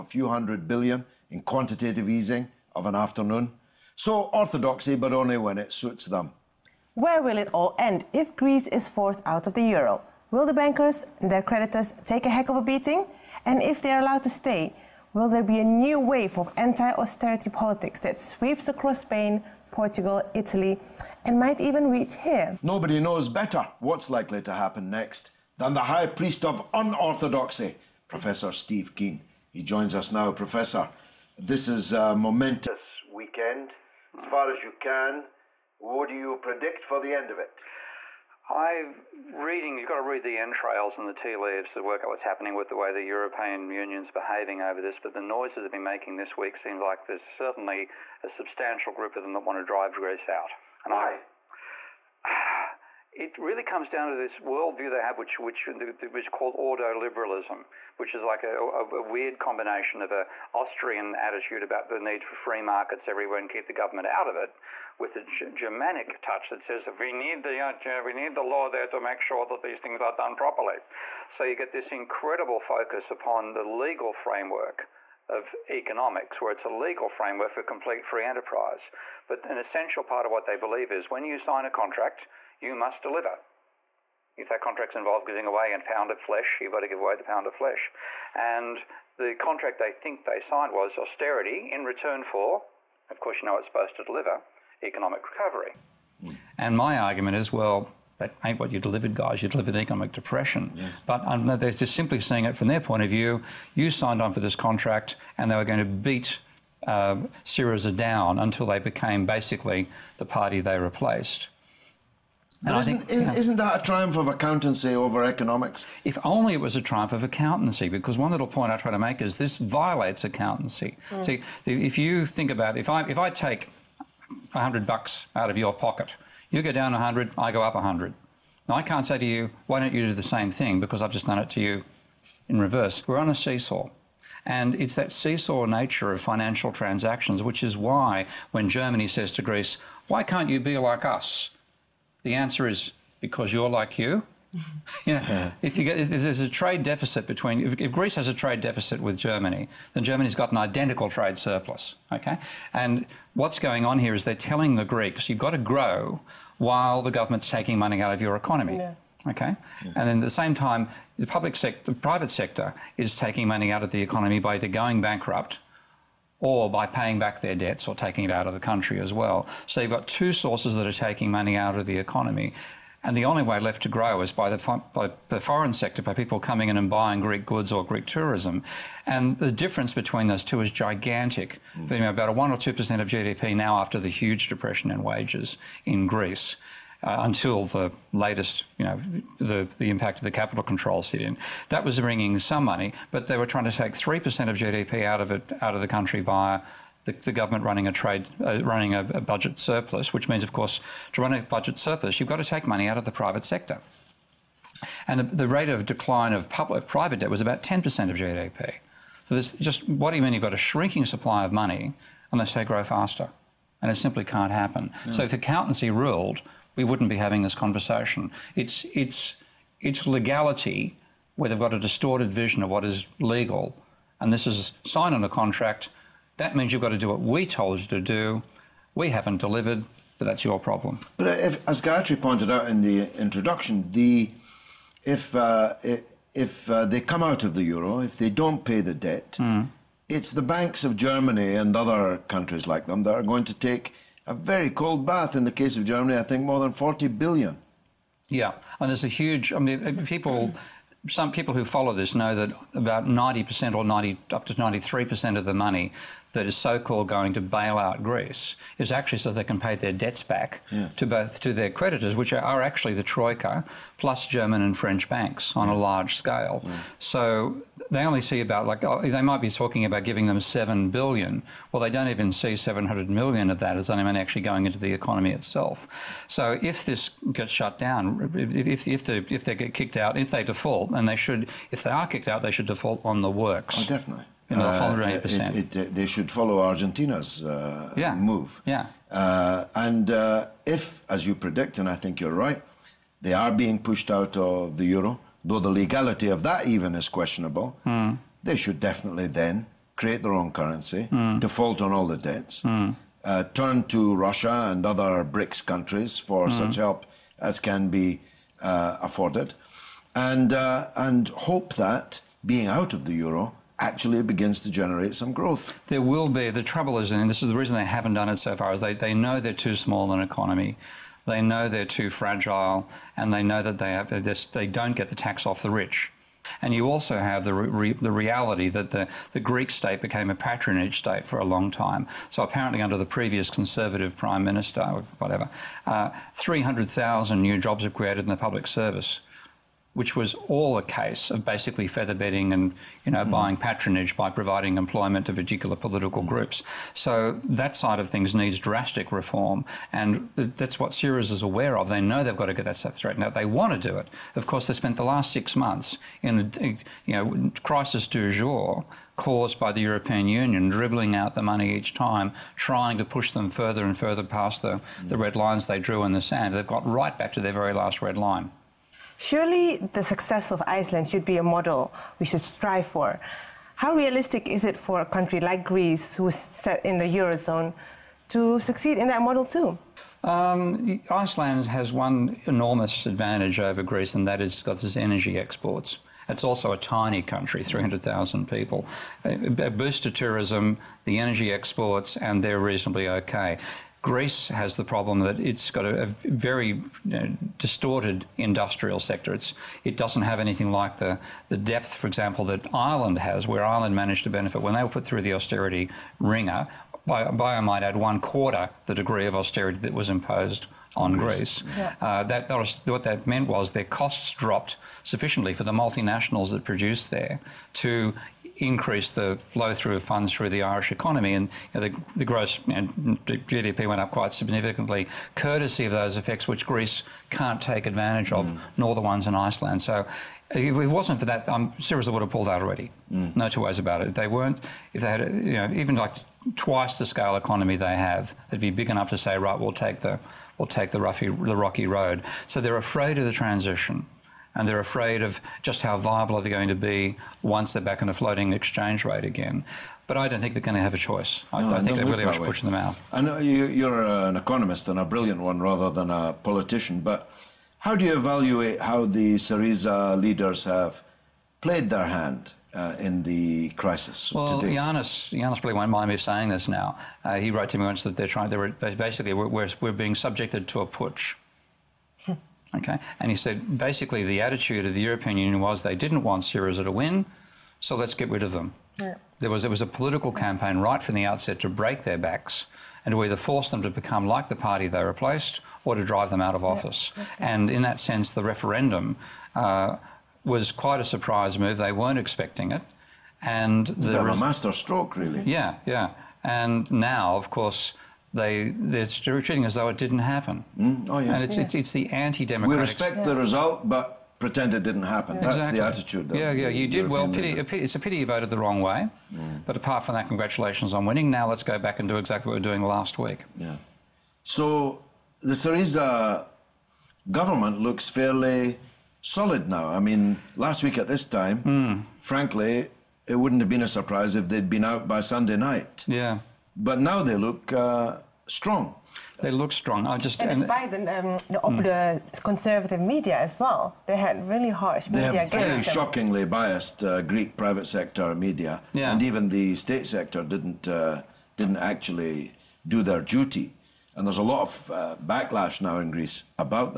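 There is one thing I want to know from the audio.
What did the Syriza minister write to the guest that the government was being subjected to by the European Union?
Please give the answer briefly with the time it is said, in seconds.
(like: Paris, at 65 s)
a putsch, at 470 s.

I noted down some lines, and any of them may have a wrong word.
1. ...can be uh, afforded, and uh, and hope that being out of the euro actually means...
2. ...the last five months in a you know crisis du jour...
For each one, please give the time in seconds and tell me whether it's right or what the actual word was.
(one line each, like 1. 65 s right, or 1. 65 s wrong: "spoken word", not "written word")
1. 307 s wrong: "begins", not "means"
2. 354 s wrong: "six", not "five".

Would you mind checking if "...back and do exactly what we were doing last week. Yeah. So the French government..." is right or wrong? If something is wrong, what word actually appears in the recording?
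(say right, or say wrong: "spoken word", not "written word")
wrong: "Syriza", not "French".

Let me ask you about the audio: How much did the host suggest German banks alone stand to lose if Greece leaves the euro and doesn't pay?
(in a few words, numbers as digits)
more than 40 billion.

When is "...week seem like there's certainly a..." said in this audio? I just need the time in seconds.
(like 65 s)
46 s.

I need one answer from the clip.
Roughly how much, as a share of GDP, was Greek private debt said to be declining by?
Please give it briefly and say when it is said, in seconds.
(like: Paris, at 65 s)
10% of GDP, at 207 s.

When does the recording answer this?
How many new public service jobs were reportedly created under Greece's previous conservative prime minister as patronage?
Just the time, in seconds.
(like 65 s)
336 s.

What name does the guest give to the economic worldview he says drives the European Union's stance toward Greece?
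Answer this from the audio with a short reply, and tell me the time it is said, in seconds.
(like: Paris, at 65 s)
ordoliberalism, at 56 s.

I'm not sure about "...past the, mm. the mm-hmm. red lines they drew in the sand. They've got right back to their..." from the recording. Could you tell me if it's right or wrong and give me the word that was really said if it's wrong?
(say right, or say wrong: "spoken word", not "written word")
right.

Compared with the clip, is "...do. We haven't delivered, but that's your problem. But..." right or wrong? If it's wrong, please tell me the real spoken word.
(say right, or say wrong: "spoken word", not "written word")
right.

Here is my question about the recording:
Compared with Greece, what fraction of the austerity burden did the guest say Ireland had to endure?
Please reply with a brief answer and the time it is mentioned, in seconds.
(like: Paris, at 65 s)
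one quarter, at 407 s.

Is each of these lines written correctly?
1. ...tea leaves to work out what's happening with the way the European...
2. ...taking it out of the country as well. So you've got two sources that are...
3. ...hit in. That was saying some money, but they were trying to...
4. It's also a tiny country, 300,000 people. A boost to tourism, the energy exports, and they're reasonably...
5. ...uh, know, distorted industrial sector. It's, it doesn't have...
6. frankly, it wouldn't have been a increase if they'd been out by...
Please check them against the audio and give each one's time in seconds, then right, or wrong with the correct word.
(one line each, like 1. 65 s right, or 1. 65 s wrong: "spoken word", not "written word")
1. 41 s right
2. 167 s right
3. 191 s wrong: "bringing", not "saying"
4. 386 s right
5. 397 s right
6. 522 s wrong: "surprise", not "increase".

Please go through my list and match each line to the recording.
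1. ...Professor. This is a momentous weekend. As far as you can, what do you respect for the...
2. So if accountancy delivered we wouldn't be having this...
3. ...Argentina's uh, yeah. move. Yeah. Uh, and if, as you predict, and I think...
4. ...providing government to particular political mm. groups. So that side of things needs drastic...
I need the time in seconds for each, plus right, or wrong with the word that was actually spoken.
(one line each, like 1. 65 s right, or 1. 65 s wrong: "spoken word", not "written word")
1. 30 s wrong: "predict", not "respect"
2. 215 s wrong: "ruled", not "delivered"
3. 286 s right
4. 344 s wrong: "employment", not "government".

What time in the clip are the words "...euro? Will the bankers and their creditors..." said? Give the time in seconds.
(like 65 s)
9 s.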